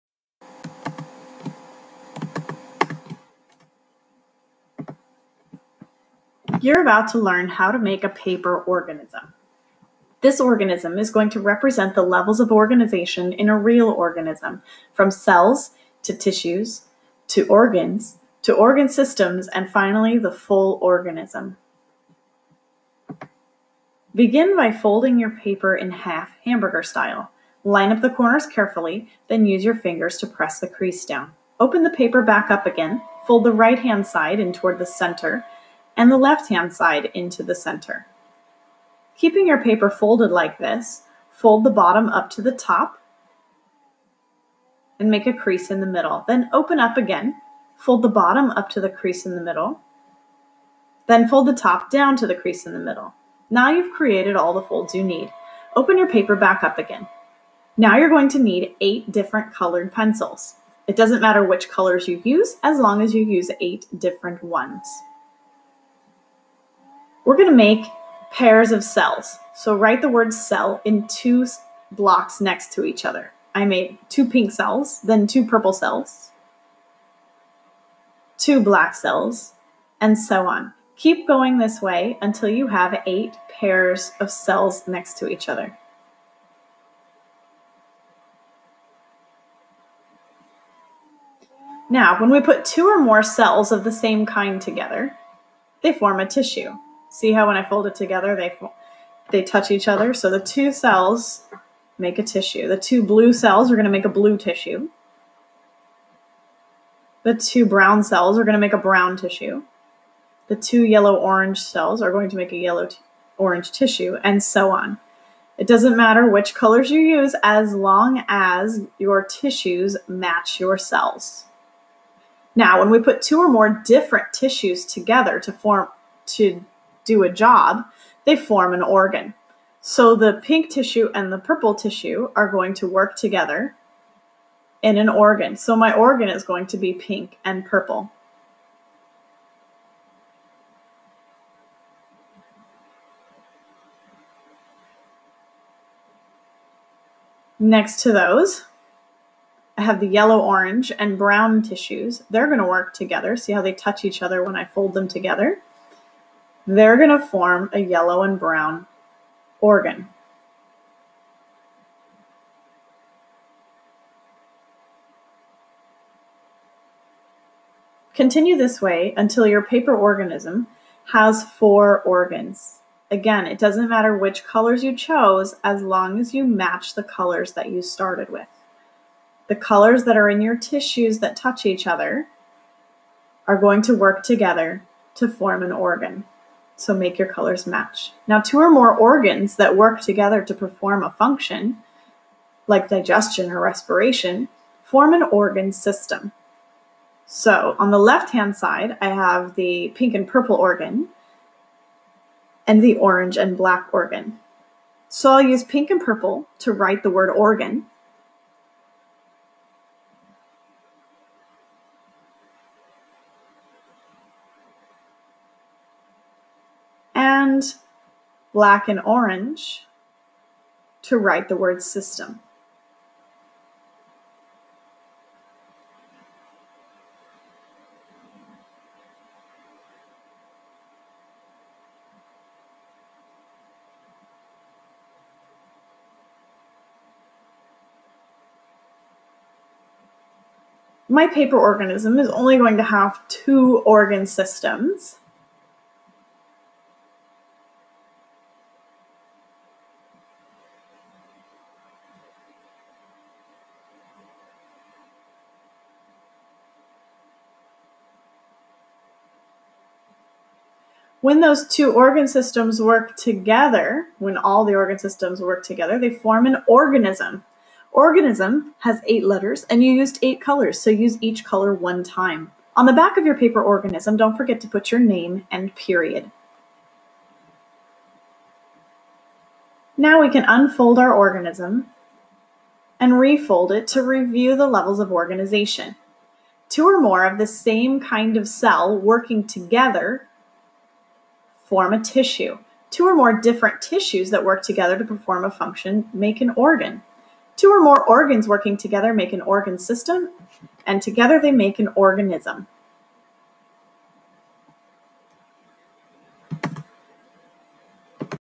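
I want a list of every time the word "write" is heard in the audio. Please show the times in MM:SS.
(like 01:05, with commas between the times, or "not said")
01:09, 03:26, 03:41.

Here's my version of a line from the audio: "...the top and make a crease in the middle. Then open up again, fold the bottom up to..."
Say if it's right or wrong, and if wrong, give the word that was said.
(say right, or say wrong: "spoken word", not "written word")
right.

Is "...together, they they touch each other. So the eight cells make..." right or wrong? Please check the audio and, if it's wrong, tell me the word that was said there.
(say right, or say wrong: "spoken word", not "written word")
wrong: "two", not "eight".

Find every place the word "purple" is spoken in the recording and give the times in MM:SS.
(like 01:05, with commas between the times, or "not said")
01:15, 02:11, 02:17, 03:20, 03:26.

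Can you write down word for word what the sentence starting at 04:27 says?
Organism has eight letters and you used eight colors, so use each color one time.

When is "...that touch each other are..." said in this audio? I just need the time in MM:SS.
03:01.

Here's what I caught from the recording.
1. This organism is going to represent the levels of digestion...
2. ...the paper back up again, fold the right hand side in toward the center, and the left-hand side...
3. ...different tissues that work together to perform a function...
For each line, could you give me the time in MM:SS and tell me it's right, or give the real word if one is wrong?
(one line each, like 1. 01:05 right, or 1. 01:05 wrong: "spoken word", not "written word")
1. 00:10 wrong: "organization", not "digestion"
2. 00:31 right
3. 04:53 right.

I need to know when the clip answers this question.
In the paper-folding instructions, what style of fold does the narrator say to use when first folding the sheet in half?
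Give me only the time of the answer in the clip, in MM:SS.
00:26.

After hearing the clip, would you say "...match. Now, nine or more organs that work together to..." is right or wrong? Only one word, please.
wrong.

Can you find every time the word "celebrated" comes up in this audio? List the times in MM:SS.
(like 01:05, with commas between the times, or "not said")
not said.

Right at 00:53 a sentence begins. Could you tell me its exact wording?
Now you've created all the folds you need.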